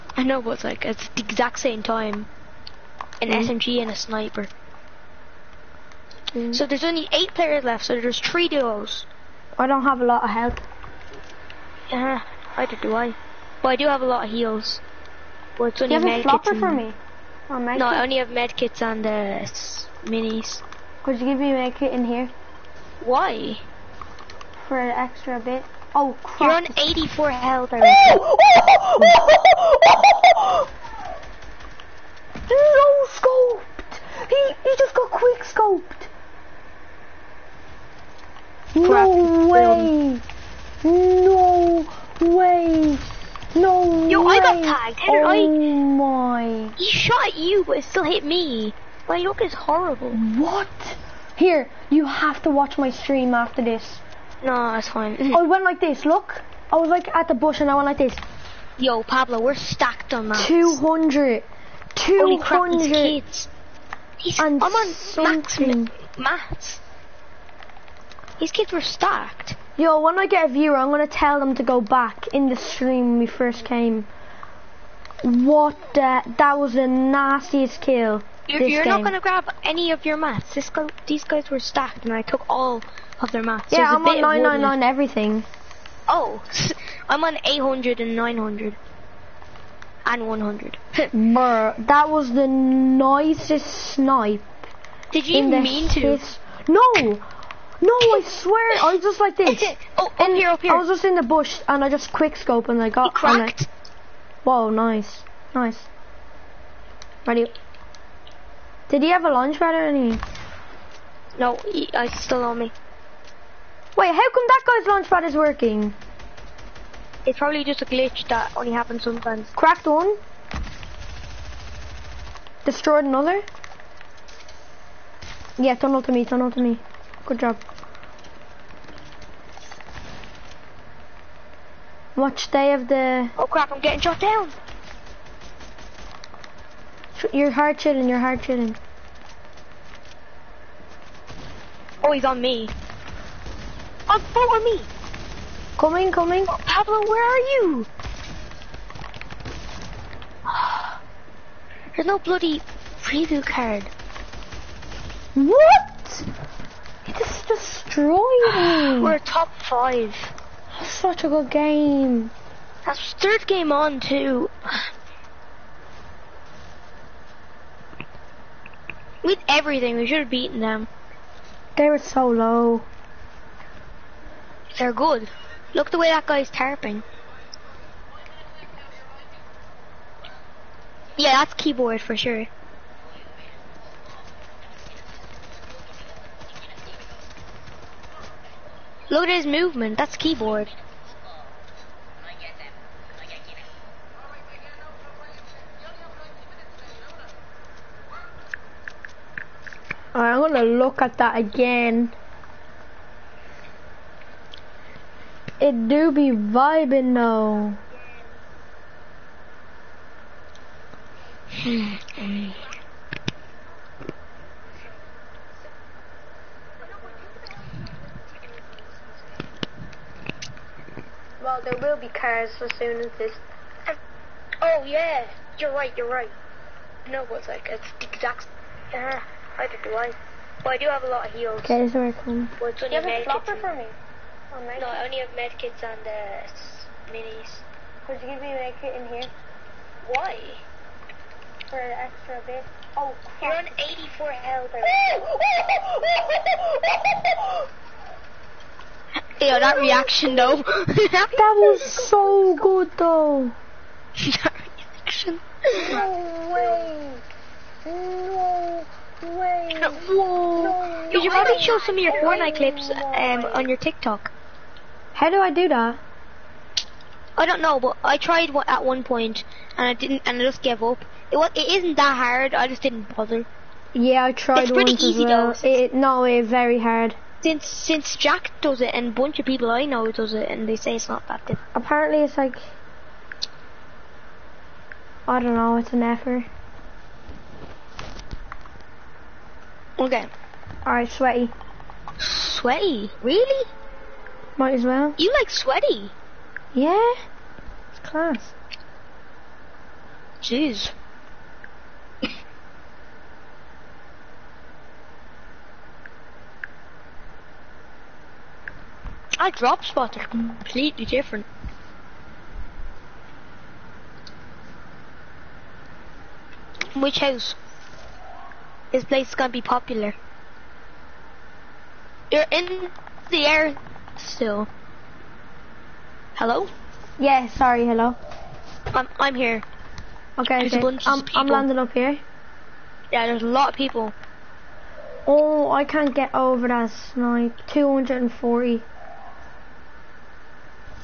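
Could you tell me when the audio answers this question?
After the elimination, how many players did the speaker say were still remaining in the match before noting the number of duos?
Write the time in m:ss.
0:07.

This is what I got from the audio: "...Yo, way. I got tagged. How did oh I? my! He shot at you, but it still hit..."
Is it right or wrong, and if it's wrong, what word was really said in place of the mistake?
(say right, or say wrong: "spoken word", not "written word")
right.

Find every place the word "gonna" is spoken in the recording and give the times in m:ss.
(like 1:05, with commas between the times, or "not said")
3:20, 5:19.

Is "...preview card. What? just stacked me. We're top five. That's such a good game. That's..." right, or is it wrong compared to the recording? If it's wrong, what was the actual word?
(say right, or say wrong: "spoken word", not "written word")
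wrong: "destroyed", not "stacked".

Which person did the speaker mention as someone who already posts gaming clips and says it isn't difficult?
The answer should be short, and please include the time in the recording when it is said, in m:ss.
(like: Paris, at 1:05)
Jack, at 4:38.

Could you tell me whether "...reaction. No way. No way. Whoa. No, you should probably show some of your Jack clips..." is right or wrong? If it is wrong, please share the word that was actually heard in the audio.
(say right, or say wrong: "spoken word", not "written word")
wrong: "Fortnite", not "Jack".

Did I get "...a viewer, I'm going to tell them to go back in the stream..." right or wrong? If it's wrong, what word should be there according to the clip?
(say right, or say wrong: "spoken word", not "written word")
right.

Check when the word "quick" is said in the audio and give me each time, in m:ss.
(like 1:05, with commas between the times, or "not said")
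0:35, 1:42.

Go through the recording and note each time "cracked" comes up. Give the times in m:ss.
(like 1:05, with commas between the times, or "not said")
1:43, 1:59.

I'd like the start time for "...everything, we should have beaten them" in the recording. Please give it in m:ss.
2:49.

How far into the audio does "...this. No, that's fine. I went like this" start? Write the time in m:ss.
0:53.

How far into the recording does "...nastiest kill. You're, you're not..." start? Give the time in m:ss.
1:16.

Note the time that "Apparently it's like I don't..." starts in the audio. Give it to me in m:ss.
4:41.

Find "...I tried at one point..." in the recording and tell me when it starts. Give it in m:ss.
4:28.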